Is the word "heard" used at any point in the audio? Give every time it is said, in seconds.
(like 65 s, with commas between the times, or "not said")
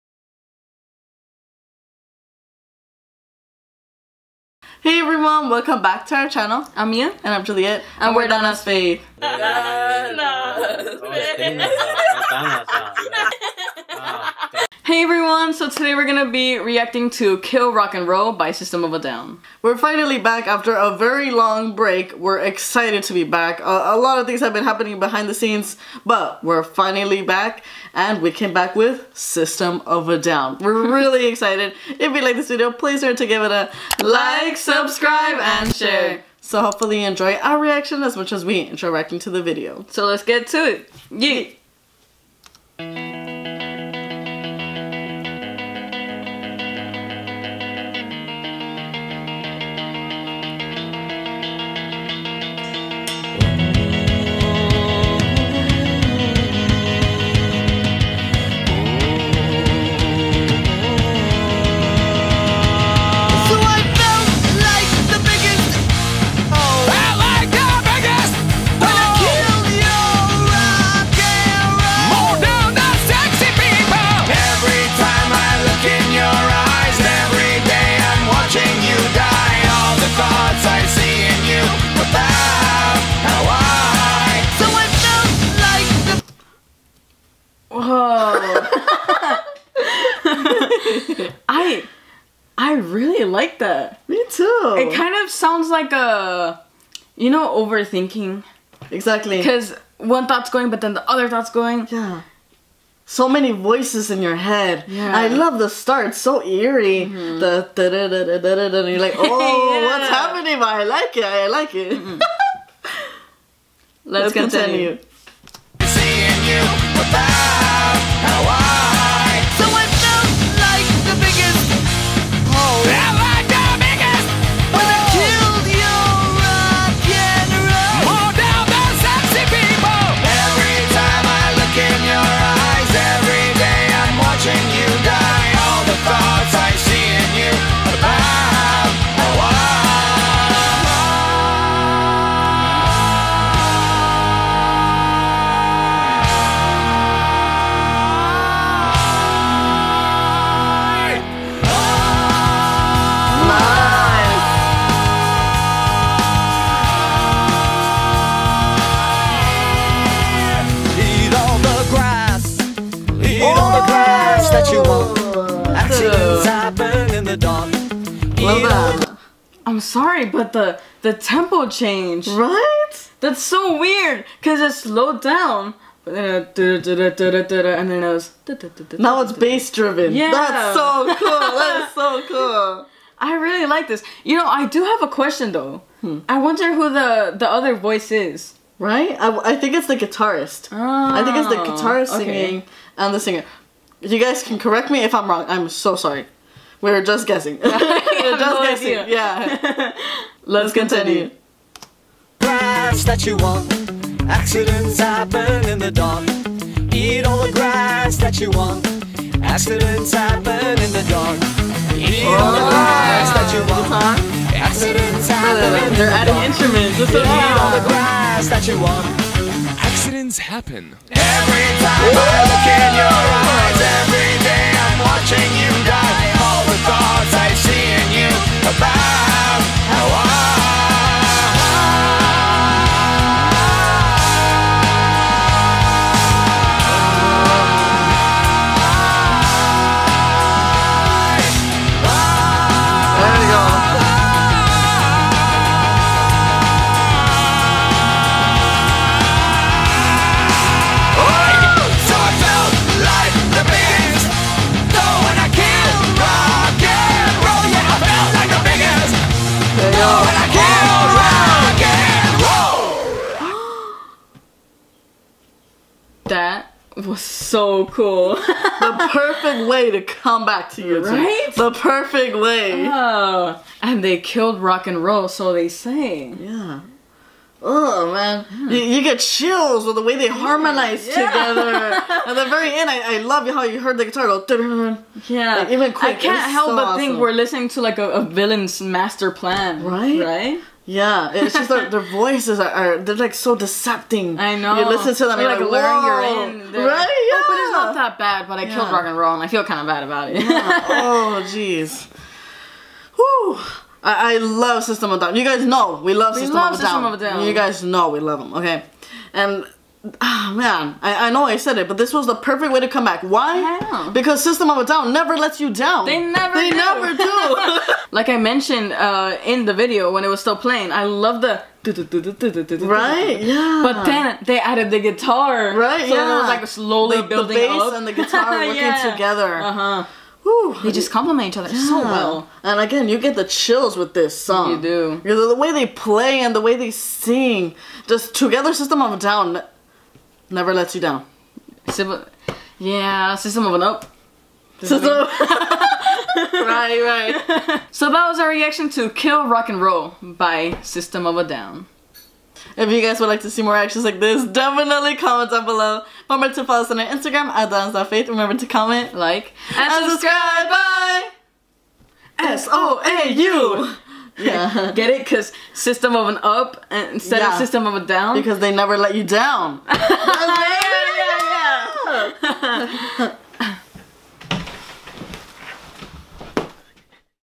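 283 s.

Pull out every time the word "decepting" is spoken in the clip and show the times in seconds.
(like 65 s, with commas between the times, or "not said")
293 s.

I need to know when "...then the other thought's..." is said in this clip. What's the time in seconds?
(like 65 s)
100 s.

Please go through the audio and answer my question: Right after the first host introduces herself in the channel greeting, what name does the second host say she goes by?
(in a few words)
Juliet.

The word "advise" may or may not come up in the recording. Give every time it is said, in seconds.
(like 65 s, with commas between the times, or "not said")
not said.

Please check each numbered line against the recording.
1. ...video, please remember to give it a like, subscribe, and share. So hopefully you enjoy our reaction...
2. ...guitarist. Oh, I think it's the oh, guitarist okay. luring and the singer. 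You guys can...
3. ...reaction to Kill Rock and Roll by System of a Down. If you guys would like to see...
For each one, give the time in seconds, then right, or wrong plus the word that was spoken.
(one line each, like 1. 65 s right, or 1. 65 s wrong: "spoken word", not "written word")
1. 32 s right
2. 189 s wrong: "singing", not "luring"
3. 348 s right.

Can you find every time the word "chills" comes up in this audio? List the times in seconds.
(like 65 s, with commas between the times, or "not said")
279 s, 333 s.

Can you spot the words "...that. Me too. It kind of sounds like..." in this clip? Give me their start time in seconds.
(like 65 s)
93 s.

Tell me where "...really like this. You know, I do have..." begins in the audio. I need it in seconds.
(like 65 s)
183 s.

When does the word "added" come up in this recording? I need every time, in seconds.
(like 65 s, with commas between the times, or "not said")
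324 s.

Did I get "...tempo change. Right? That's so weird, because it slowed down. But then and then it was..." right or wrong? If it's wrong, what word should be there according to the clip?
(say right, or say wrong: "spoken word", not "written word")
right.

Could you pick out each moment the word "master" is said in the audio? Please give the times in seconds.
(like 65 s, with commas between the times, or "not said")
288 s.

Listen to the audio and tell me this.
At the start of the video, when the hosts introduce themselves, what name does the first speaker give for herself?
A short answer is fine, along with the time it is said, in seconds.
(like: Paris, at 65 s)
Mia, at 6 s.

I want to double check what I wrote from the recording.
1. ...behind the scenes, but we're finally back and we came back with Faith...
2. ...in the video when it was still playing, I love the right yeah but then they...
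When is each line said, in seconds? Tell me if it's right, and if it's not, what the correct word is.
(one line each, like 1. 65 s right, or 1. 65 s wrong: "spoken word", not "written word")
1. 24 s wrong: "System", not "Faith"
2. 319 s right.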